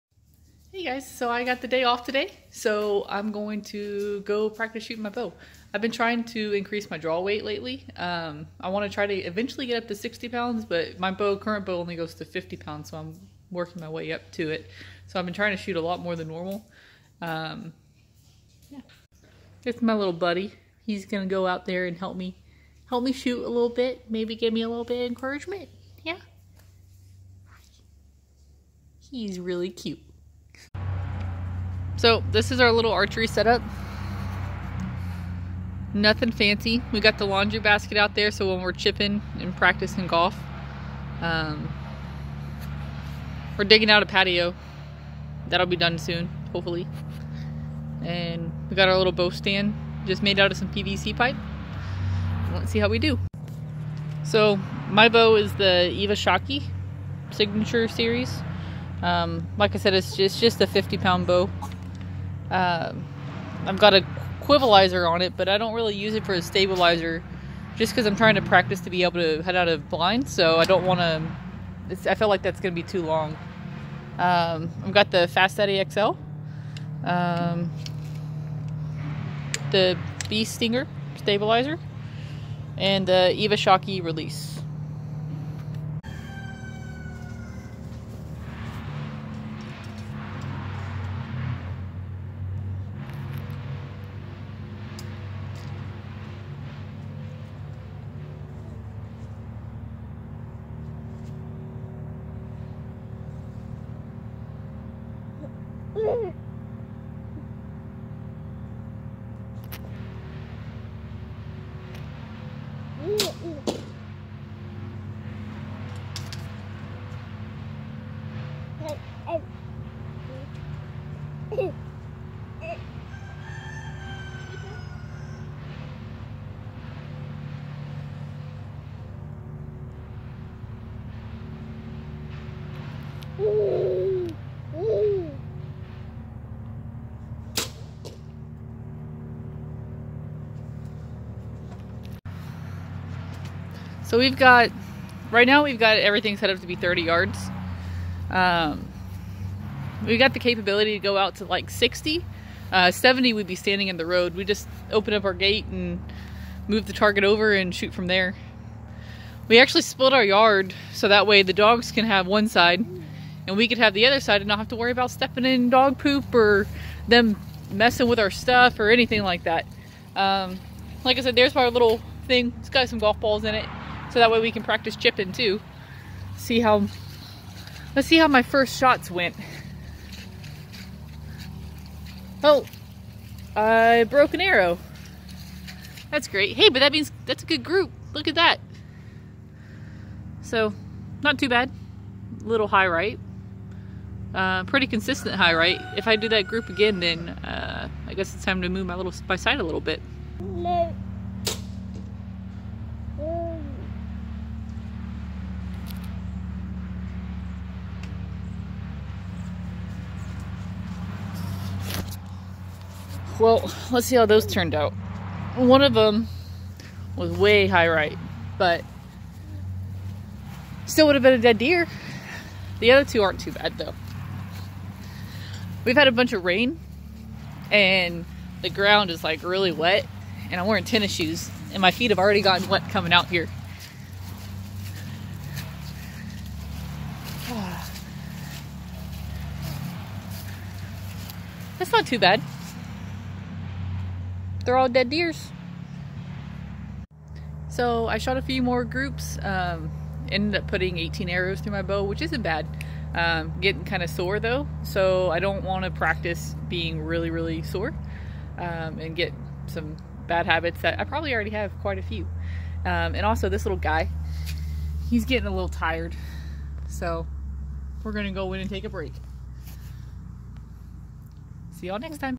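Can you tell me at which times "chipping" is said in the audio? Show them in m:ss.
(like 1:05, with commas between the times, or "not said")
0:38, 2:54.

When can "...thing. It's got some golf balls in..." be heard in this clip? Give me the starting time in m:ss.
2:52.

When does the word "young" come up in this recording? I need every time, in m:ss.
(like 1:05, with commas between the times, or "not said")
not said.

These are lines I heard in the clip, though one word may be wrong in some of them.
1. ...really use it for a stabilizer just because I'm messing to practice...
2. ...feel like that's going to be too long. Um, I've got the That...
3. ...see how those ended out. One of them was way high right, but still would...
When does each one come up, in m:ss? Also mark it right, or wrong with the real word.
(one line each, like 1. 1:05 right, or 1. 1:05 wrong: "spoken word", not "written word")
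1. 1:05 wrong: "trying", not "messing"
2. 1:12 wrong: "Fast", not "That"
3. 3:34 wrong: "turned", not "ended".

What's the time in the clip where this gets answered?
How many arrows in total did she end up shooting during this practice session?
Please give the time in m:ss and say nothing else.
4:10.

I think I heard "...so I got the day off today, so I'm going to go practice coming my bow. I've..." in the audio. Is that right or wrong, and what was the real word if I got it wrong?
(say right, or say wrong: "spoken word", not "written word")
wrong: "shooting", not "coming".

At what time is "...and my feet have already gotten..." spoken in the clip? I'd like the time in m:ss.
3:51.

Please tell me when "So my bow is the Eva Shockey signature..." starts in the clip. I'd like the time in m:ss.
0:54.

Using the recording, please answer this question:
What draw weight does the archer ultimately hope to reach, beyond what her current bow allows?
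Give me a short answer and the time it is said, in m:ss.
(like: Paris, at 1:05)
60 pounds, at 0:09.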